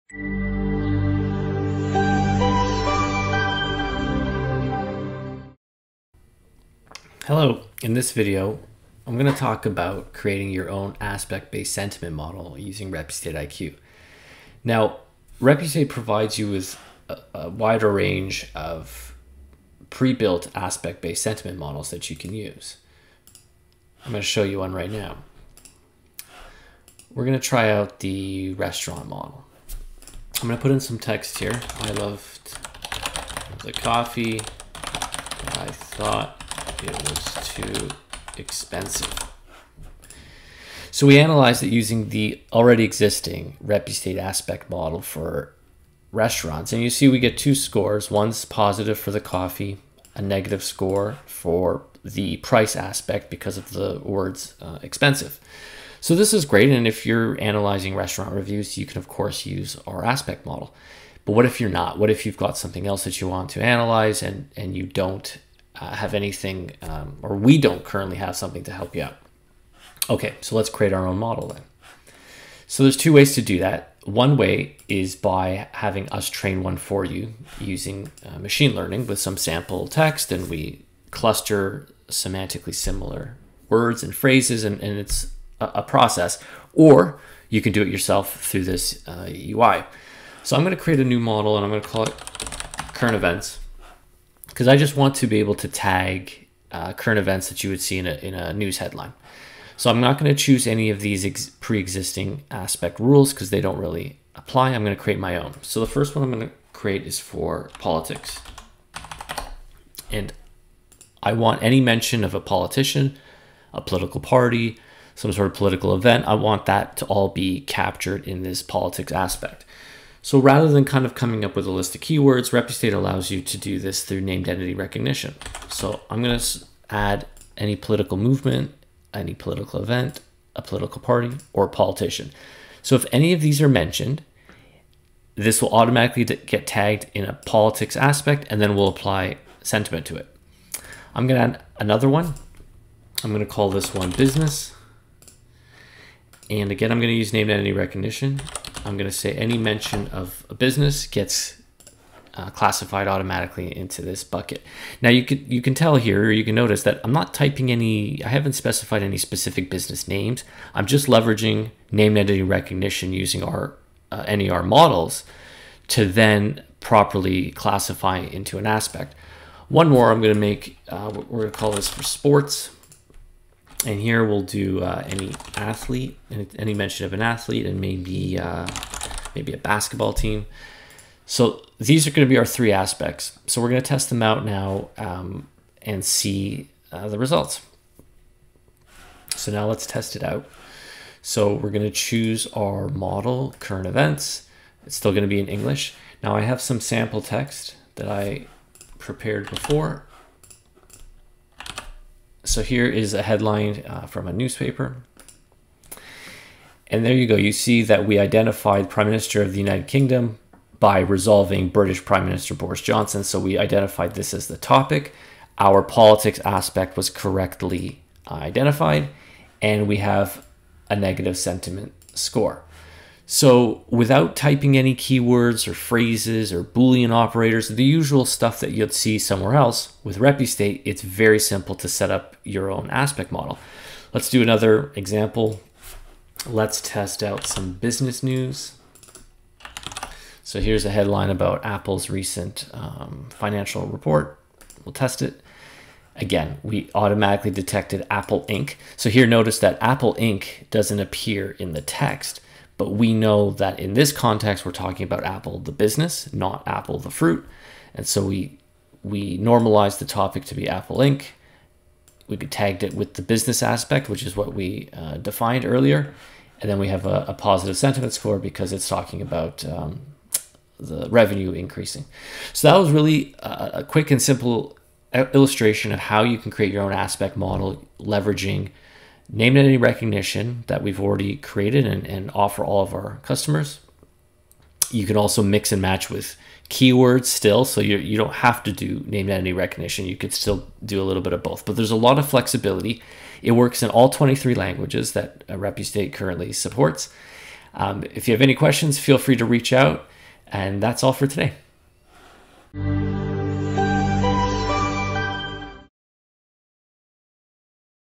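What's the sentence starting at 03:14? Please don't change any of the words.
It's still going to be in English.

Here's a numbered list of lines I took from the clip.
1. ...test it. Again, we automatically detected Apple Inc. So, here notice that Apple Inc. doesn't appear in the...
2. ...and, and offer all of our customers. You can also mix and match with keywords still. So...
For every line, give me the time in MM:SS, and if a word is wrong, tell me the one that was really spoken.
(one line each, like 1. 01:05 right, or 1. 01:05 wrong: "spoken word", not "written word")
1. 04:04 right
2. 04:41 right.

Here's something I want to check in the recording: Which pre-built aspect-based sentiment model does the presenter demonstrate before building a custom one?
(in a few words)
Restaurant model.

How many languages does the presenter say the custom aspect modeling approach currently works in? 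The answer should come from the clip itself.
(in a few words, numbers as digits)
23.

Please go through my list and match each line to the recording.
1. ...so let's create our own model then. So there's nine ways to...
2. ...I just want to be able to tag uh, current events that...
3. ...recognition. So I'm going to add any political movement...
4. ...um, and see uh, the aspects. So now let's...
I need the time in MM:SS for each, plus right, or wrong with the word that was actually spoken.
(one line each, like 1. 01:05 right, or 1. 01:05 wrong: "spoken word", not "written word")
1. 01:10 wrong: "two", not "nine"
2. 01:34 right
3. 02:04 right
4. 03:04 wrong: "results", not "aspects".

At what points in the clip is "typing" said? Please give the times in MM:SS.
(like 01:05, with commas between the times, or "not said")
02:37, 03:44.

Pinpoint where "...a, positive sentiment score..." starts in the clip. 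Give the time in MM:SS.
04:27.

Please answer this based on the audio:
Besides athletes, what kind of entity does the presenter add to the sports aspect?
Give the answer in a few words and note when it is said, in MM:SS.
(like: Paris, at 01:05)
Basketball team, at 02:59.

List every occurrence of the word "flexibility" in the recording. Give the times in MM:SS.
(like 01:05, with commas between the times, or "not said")
04:52.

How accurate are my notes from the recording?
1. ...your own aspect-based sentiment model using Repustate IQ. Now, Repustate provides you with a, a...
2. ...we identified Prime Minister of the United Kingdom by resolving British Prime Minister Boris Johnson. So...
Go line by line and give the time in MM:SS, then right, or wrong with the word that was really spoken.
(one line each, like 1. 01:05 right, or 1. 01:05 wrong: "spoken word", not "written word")
1. 00:10 right
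2. 03:28 right.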